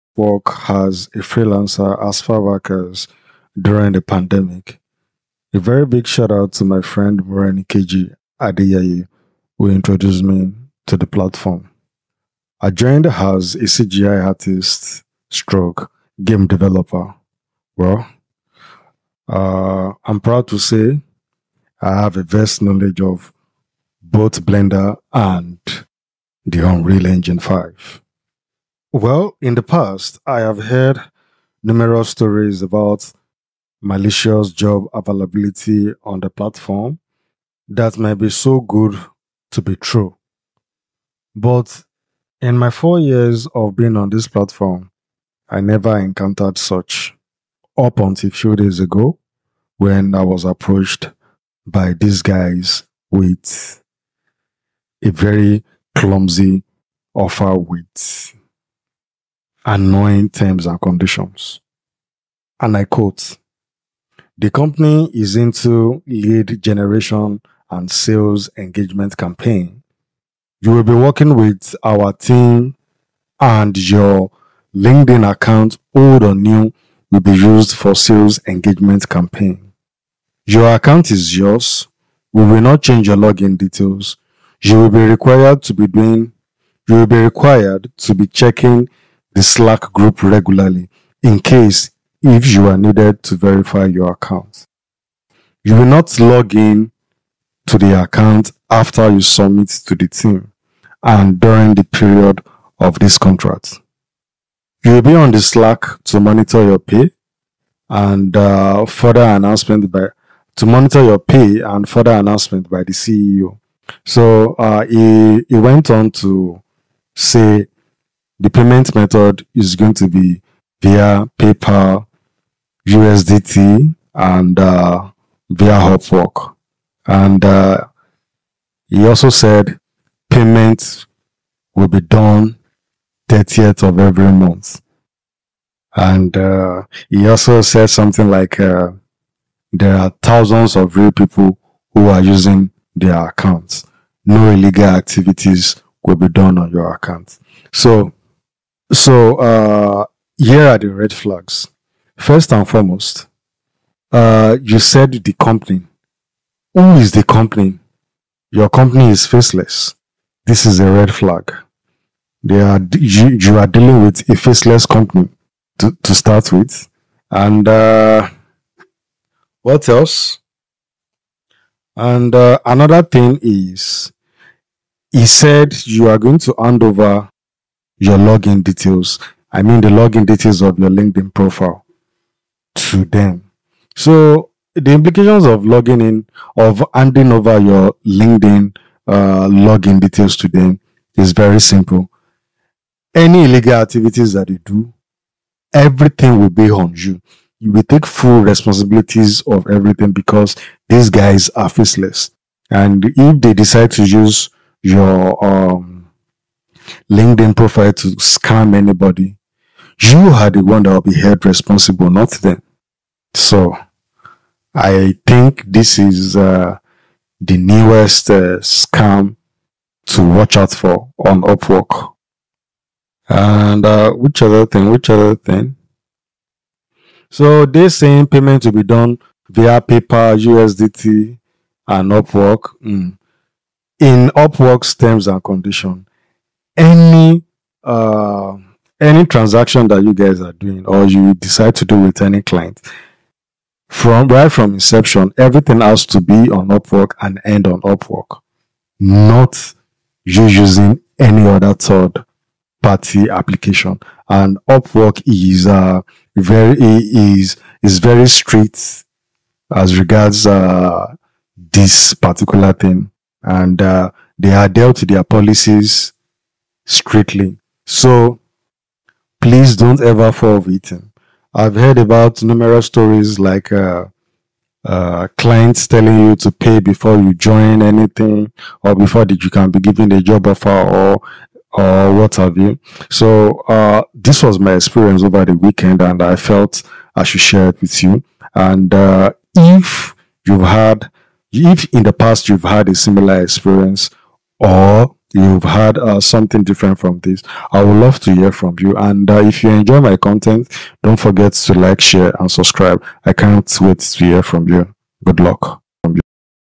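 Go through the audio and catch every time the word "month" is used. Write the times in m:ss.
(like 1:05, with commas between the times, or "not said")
2:14.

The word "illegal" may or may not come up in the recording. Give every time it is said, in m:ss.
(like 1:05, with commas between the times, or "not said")
2:24, 3:13.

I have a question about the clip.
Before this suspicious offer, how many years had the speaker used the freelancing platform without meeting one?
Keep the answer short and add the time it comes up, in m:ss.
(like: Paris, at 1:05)
4, at 0:42.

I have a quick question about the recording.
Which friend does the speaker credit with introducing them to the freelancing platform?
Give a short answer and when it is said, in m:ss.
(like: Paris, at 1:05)
KG Adeyeye, at 0:07.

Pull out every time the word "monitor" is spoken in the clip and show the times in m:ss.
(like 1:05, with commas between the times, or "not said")
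1:46, 1:50.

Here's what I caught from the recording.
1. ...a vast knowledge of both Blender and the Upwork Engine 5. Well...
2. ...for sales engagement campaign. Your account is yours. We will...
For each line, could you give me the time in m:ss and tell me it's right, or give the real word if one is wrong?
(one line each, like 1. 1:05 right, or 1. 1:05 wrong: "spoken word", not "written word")
1. 0:22 wrong: "Unreal", not "Upwork"
2. 1:17 right.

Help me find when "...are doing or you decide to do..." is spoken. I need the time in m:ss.
4:00.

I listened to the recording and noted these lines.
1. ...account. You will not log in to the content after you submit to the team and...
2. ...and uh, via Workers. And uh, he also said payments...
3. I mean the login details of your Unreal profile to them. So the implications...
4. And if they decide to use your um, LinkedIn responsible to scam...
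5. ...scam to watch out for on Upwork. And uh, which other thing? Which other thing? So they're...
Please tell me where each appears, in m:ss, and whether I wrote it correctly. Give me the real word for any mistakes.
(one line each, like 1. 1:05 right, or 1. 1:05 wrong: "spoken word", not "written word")
1. 1:34 wrong: "account", not "content"
2. 2:04 wrong: "Upwork", not "Workers"
3. 2:59 wrong: "LinkedIn", not "Unreal"
4. 3:22 wrong: "profile", not "responsible"
5. 3:38 right.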